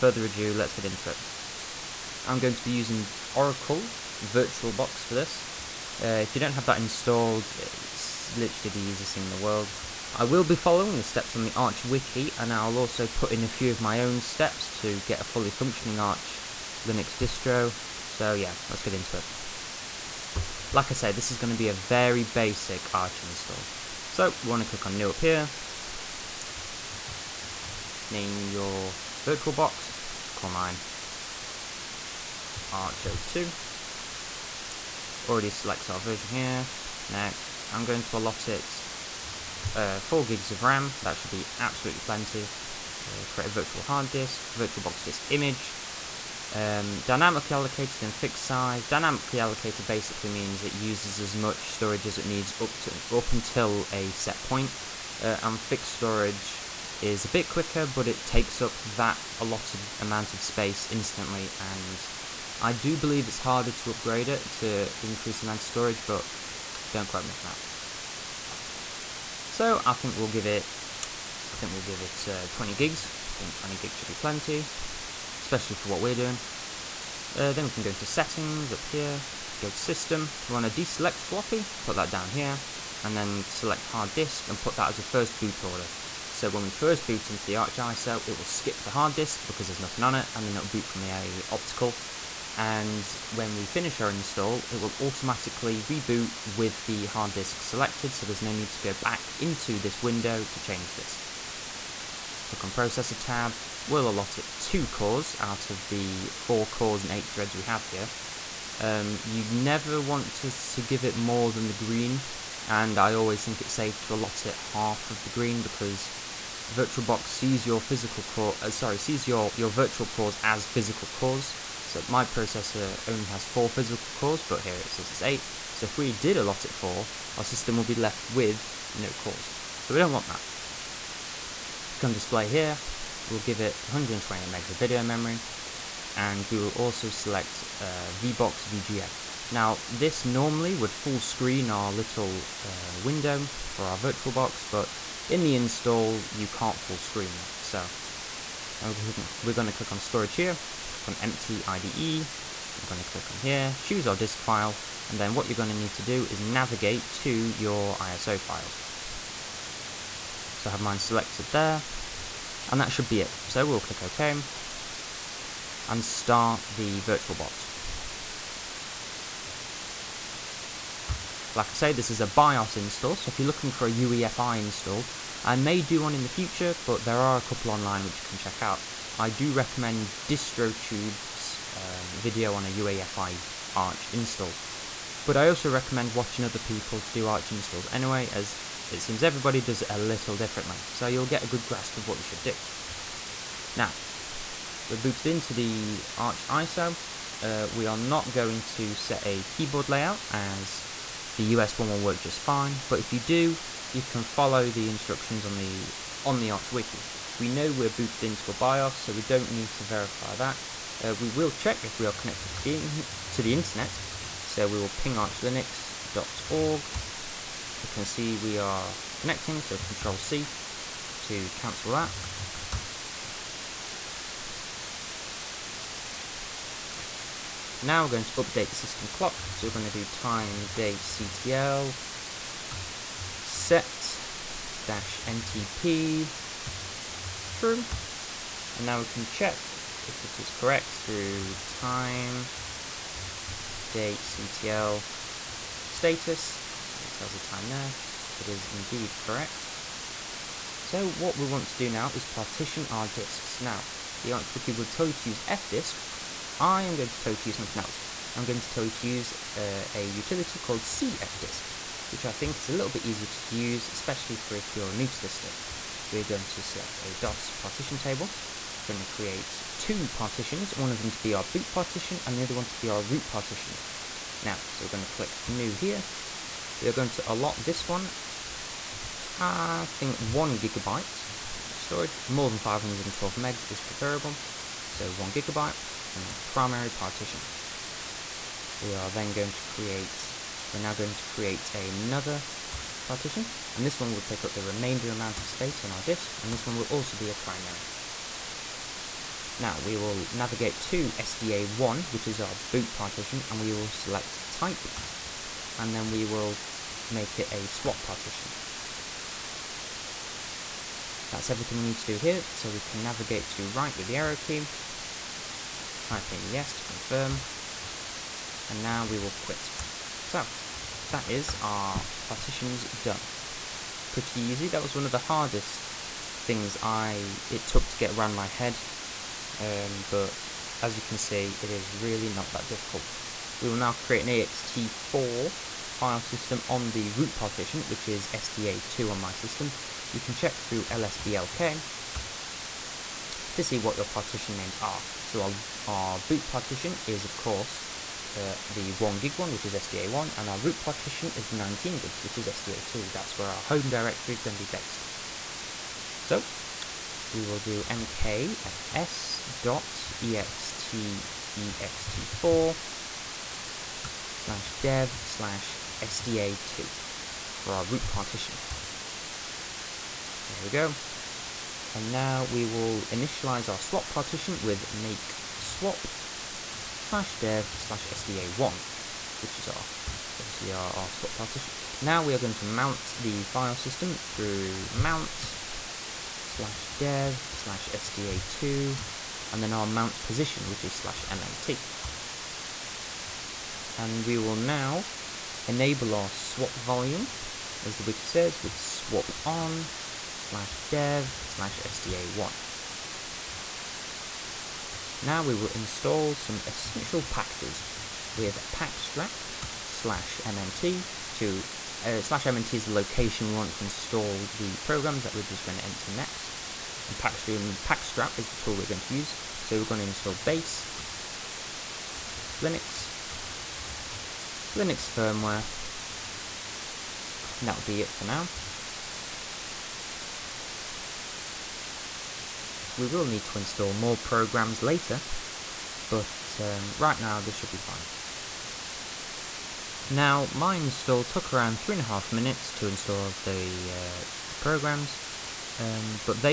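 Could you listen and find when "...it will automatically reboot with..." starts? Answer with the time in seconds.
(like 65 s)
94 s.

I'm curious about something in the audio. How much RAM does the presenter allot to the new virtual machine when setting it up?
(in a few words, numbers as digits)
4 GB.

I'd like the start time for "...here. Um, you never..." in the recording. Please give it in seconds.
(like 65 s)
107 s.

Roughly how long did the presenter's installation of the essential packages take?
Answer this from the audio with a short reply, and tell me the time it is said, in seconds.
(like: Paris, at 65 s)
3.5 minutes, at 441 s.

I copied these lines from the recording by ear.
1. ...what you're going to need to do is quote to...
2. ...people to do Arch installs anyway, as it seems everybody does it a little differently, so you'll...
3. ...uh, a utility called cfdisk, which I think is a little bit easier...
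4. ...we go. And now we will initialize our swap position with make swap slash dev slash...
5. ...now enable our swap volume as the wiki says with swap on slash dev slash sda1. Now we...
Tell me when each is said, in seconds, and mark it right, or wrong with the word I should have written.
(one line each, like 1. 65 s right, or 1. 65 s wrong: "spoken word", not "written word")
1. 155 s wrong: "navigate", not "quote"
2. 186 s right
3. 259 s right
4. 370 s wrong: "partition", not "position"
5. 394 s right.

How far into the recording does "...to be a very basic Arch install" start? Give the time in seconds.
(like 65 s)
21 s.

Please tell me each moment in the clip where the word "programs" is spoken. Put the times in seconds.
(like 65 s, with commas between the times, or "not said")
414 s, 434 s, 444 s.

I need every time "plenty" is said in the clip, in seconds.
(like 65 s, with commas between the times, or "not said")
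42 s, 74 s.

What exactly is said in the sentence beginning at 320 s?
So, that is our partitions done.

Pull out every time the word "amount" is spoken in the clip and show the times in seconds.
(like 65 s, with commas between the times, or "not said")
59 s, 65 s, 295 s.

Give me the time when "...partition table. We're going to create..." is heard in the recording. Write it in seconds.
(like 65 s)
267 s.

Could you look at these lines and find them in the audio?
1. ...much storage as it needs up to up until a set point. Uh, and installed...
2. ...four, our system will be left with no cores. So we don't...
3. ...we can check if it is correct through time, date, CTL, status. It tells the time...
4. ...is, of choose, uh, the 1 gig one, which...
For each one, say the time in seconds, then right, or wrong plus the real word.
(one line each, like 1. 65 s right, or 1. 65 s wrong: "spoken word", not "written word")
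1. 51 s wrong: "fixed", not "installed"
2. 126 s right
3. 238 s right
4. 347 s wrong: "course", not "choose".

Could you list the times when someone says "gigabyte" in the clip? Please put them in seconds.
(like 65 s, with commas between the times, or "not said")
280 s, 285 s.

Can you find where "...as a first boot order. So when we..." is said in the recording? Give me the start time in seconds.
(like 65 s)
84 s.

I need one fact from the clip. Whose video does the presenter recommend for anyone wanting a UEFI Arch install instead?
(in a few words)
DistroTube.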